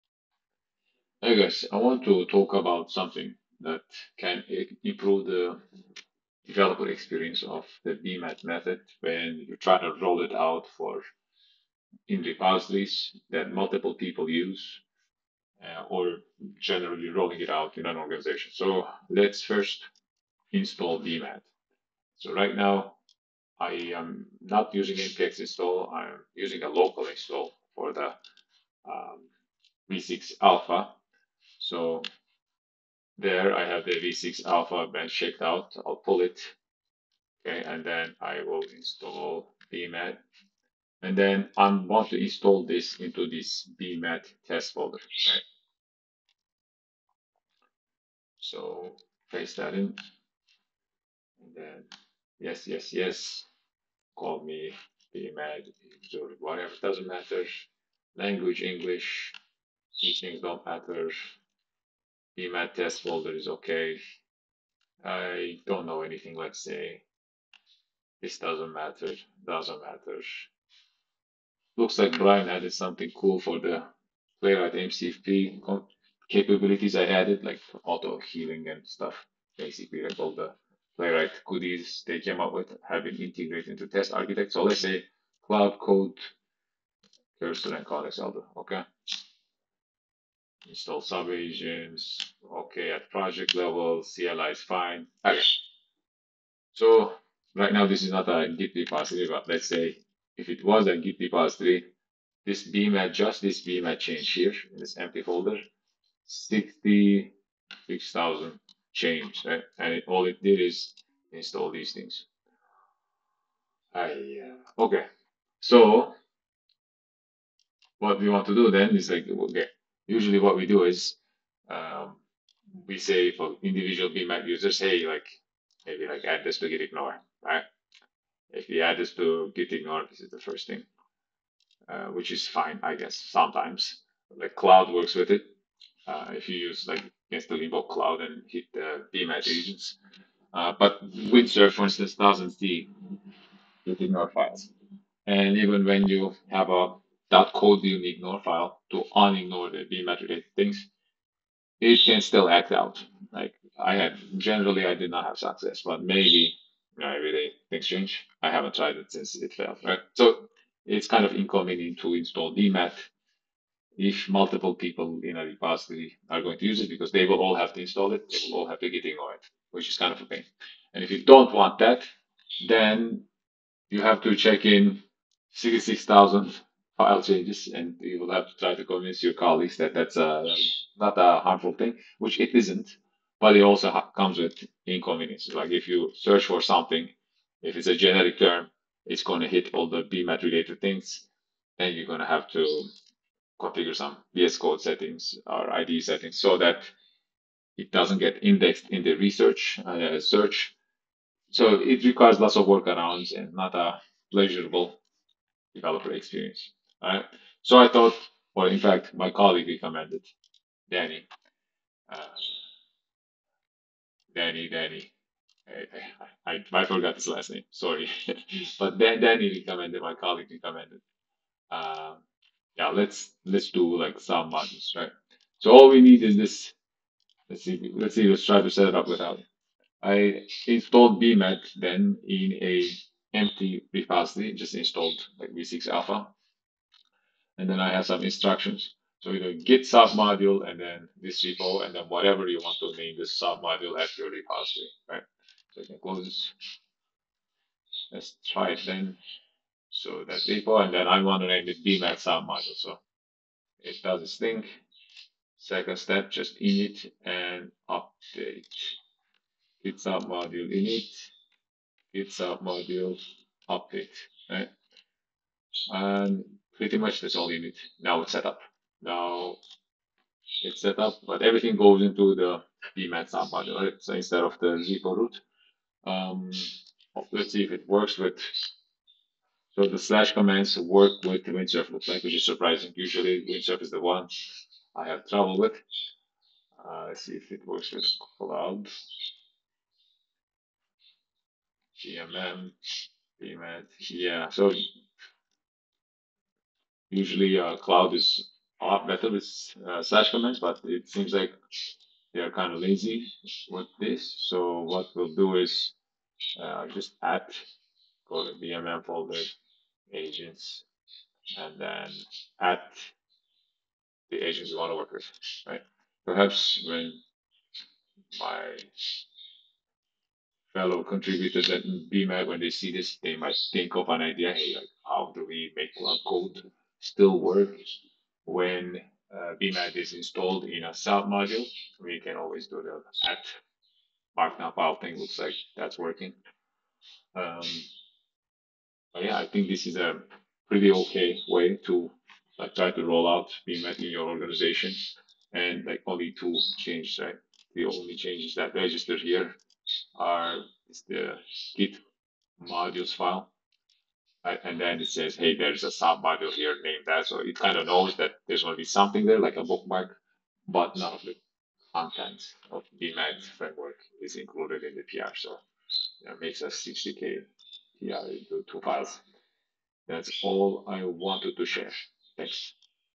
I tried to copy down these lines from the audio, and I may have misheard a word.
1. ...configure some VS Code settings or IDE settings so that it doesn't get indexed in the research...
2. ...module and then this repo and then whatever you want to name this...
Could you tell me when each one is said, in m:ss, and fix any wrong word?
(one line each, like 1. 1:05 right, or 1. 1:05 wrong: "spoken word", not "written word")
1. 3:13 right
2. 4:00 right.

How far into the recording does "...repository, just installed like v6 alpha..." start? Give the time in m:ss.
3:53.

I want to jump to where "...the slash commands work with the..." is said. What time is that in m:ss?
4:39.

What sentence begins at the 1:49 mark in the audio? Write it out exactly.
And it, all it did is install these things.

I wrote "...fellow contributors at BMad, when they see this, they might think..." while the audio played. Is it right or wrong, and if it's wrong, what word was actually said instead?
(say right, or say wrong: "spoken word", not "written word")
right.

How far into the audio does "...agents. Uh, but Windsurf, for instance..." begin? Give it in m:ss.
2:19.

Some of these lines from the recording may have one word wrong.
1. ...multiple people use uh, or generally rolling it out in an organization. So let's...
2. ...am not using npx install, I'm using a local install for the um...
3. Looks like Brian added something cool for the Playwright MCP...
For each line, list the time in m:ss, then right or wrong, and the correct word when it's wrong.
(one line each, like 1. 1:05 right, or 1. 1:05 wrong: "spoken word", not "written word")
1. 0:13 right
2. 0:23 right
3. 1:11 right.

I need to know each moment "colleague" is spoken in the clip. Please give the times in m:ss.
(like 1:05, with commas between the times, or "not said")
2:59, 3:29, 3:40.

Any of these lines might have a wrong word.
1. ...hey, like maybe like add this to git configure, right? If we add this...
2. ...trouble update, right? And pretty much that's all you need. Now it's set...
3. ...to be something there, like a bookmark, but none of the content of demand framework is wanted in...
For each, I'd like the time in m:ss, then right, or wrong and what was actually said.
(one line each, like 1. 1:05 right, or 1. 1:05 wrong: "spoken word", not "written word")
1. 2:04 wrong: "ignore", not "configure"
2. 4:22 wrong: "module", not "trouble"
3. 5:58 wrong: "included", not "wanted".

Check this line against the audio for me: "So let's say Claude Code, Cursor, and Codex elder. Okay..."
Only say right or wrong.
right.